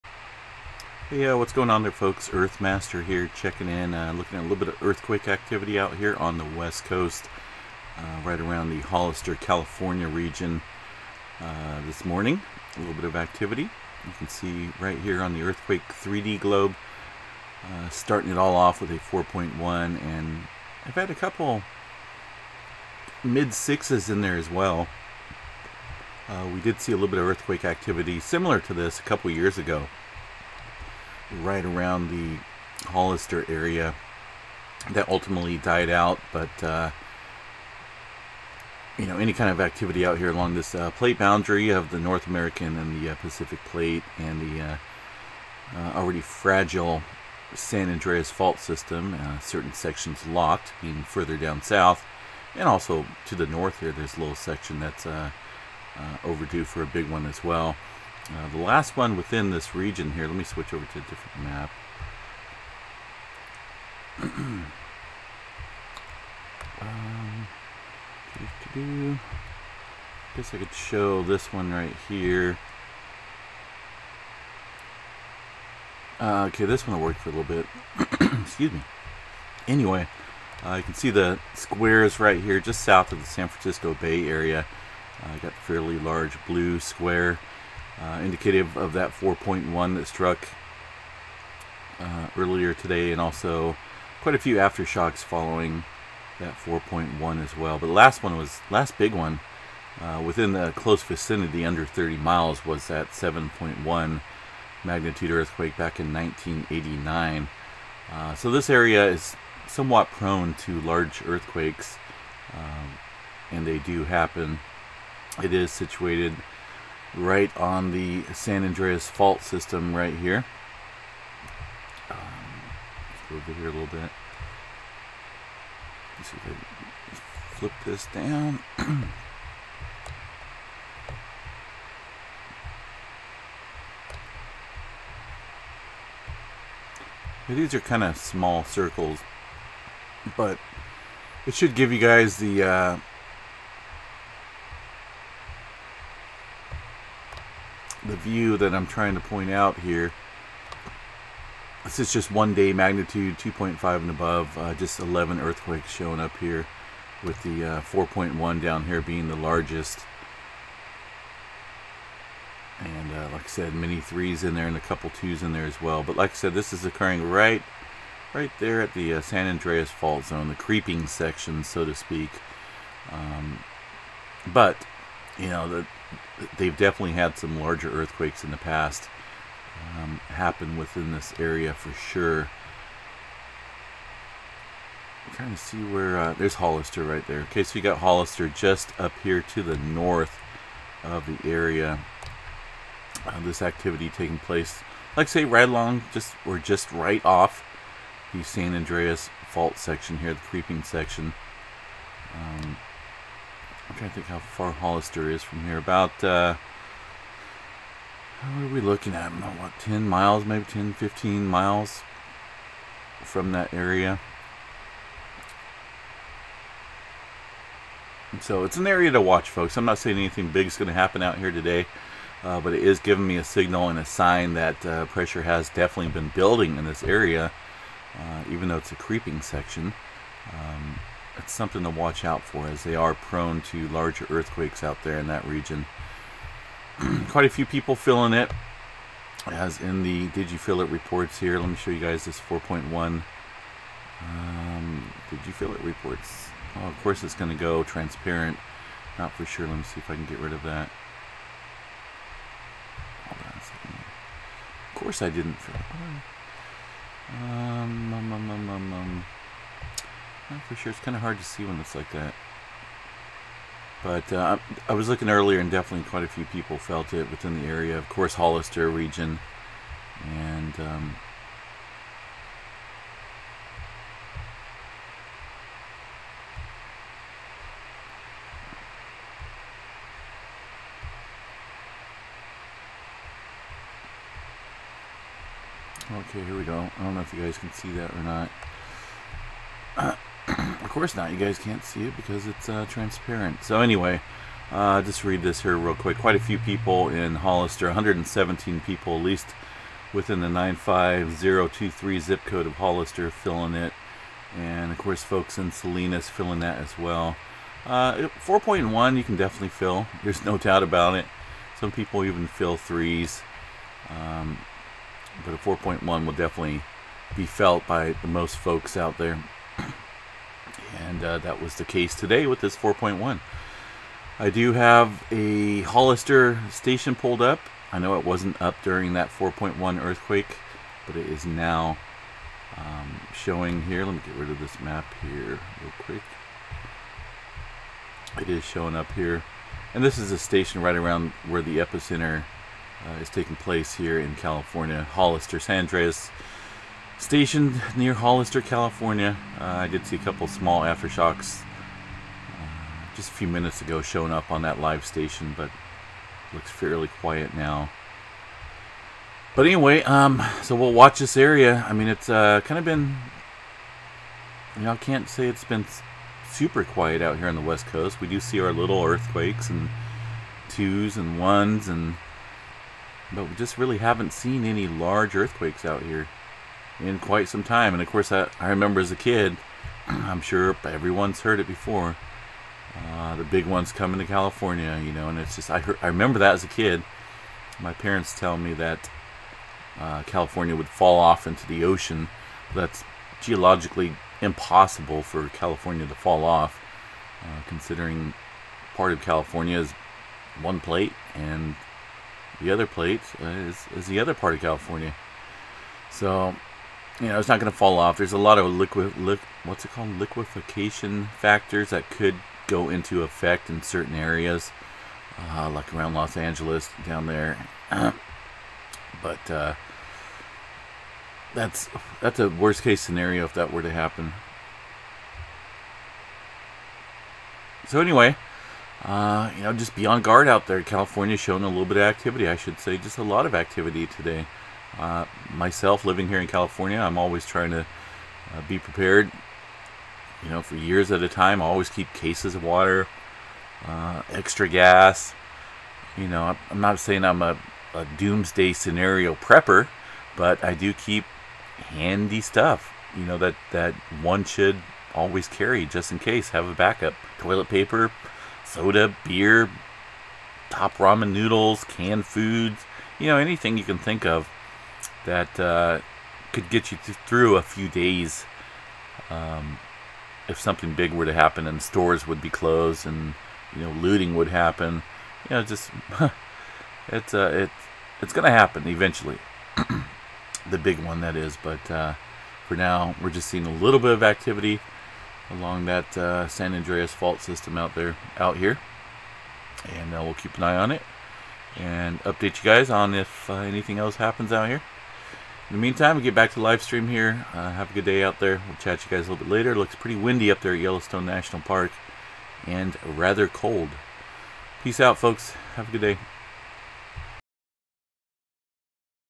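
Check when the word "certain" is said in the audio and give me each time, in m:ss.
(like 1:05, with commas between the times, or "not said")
0:49, 6:53.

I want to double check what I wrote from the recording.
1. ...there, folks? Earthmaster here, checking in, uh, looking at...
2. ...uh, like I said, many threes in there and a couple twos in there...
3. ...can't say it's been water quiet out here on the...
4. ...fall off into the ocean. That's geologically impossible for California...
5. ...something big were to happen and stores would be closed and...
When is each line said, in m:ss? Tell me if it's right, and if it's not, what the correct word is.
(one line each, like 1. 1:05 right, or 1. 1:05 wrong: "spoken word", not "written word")
1. 0:01 right
2. 2:43 right
3. 6:04 wrong: "super", not "water"
4. 6:30 right
5. 7:50 right.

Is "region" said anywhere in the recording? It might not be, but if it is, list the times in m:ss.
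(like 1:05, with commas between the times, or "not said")
0:10, 0:59, 3:55, 4:28.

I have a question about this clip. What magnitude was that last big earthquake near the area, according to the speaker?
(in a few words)
7.1.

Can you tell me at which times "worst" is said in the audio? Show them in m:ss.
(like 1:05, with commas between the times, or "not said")
7:02.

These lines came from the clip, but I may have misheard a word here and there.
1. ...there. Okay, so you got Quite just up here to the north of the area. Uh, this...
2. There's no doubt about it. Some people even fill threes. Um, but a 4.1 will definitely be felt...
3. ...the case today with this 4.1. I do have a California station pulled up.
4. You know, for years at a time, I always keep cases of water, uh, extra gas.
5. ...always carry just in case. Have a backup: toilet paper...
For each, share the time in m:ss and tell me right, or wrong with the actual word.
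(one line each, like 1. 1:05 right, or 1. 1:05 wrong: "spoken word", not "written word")
1. 3:07 wrong: "Hollister", not "Quite"
2. 5:10 right
3. 5:21 wrong: "Hollister", not "California"
4. 7:20 right
5. 7:35 right.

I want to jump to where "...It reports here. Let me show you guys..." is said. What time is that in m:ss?
4:00.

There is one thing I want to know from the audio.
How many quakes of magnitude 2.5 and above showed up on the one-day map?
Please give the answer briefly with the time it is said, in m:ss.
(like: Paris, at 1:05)
11, at 2:34.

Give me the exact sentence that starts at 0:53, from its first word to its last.
There's a little section that's overdue for a big one as well.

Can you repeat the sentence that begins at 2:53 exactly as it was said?
Um, but, you know, the they've definitely had some larger earthquakes in the past um, happen within this area for sure.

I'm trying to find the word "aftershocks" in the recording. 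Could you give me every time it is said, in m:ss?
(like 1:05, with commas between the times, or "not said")
1:34, 5:50.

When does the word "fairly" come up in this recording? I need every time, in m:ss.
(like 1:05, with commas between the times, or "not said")
1:25, 5:56.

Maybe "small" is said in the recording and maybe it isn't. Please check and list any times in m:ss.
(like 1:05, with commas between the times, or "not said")
2:18, 5:50.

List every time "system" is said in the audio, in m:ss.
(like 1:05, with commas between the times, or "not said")
0:48, 1:59, 8:07.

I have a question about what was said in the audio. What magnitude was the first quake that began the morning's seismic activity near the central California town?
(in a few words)
4.1.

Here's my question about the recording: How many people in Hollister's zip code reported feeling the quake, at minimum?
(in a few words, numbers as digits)
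117.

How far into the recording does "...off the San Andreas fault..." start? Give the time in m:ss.
3:17.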